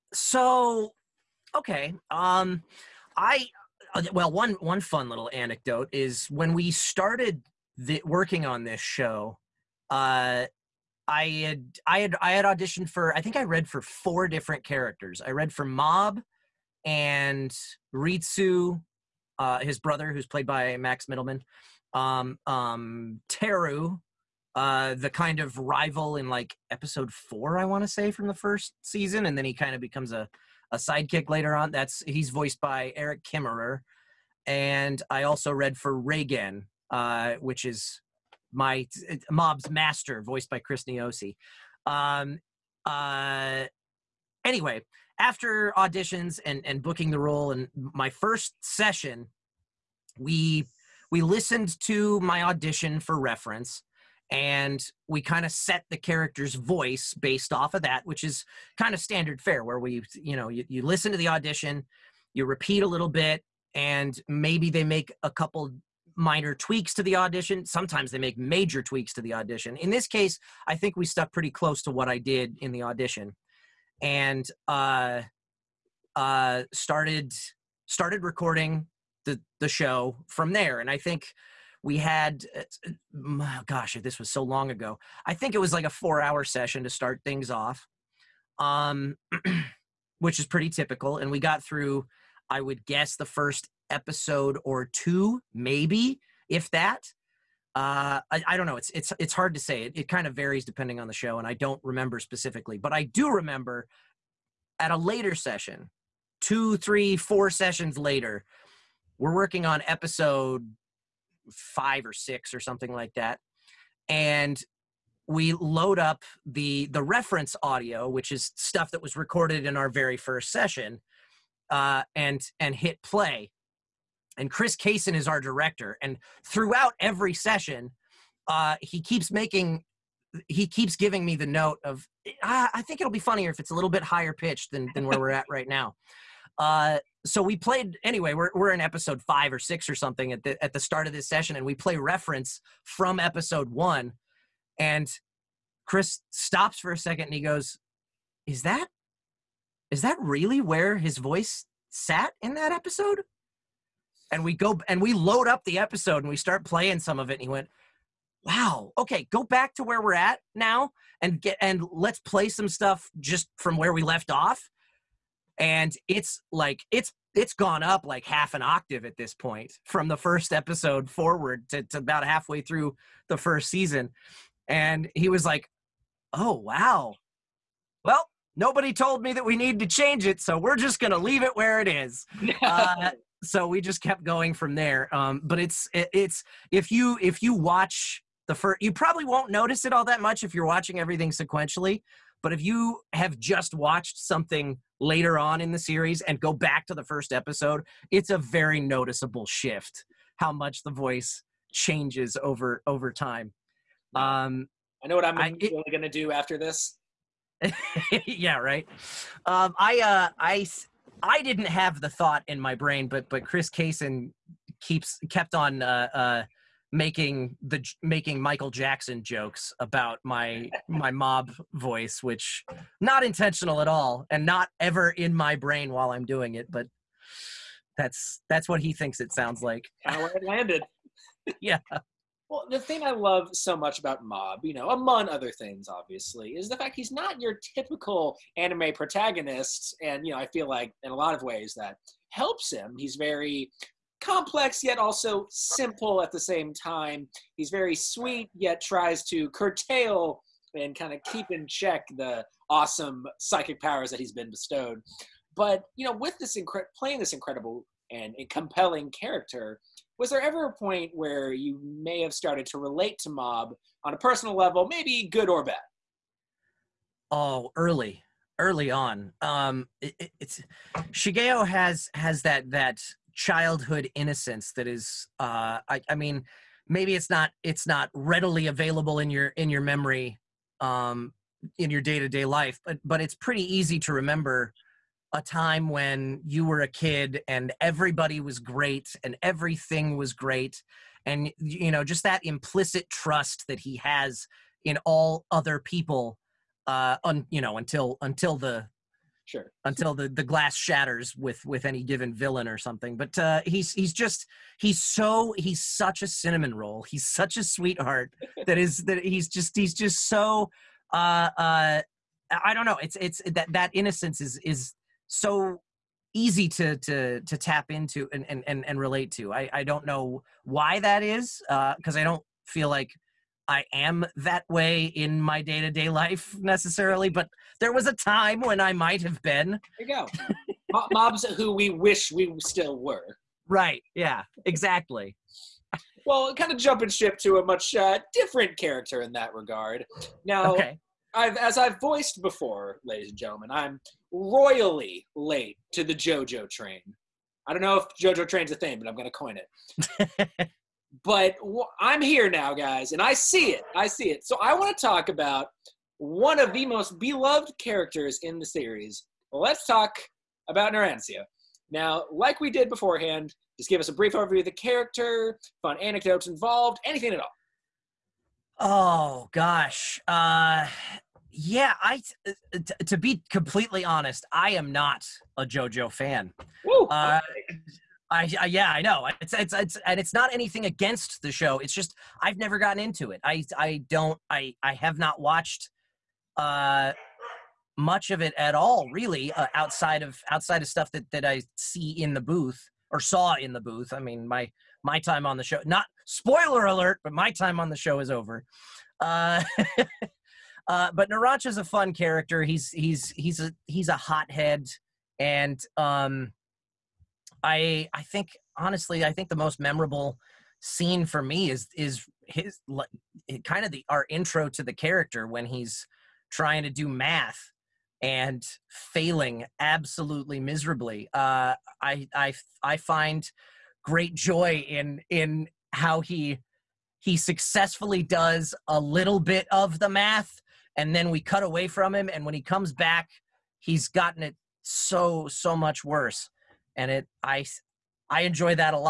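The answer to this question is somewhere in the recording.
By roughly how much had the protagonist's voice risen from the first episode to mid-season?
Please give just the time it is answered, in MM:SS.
02:48.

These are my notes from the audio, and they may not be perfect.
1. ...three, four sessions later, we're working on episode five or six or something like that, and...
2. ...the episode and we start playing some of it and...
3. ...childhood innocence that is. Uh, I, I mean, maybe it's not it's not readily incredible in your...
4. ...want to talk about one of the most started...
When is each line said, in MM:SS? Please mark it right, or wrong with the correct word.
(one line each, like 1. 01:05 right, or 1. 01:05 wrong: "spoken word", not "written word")
1. 01:46 right
2. 02:35 right
3. 04:33 wrong: "available", not "incredible"
4. 05:54 wrong: "beloved", not "started".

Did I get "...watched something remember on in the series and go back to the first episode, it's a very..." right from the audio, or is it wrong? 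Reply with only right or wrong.
wrong.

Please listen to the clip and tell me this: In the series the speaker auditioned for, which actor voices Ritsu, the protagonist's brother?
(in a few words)
Max Mittelman.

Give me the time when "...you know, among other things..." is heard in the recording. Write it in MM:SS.
03:54.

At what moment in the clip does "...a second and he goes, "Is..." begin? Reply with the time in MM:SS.
02:26.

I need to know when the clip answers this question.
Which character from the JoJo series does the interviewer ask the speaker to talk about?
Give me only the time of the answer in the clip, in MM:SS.
06:00.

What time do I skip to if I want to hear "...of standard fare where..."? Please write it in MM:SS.
00:58.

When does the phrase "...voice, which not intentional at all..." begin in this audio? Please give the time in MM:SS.
03:41.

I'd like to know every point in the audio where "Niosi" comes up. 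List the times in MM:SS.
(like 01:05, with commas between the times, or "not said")
00:40.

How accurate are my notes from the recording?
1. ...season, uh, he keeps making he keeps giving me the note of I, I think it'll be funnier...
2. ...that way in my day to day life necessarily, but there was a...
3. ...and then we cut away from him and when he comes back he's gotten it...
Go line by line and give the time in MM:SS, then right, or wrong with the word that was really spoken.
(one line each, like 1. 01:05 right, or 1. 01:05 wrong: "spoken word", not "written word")
1. 02:07 wrong: "session", not "season"
2. 05:24 right
3. 07:10 right.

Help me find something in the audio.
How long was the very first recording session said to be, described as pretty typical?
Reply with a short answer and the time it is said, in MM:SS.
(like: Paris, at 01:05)
4 hours, at 01:25.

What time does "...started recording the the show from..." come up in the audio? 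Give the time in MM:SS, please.
01:17.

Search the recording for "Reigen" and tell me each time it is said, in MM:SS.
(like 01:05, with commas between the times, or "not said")
00:35.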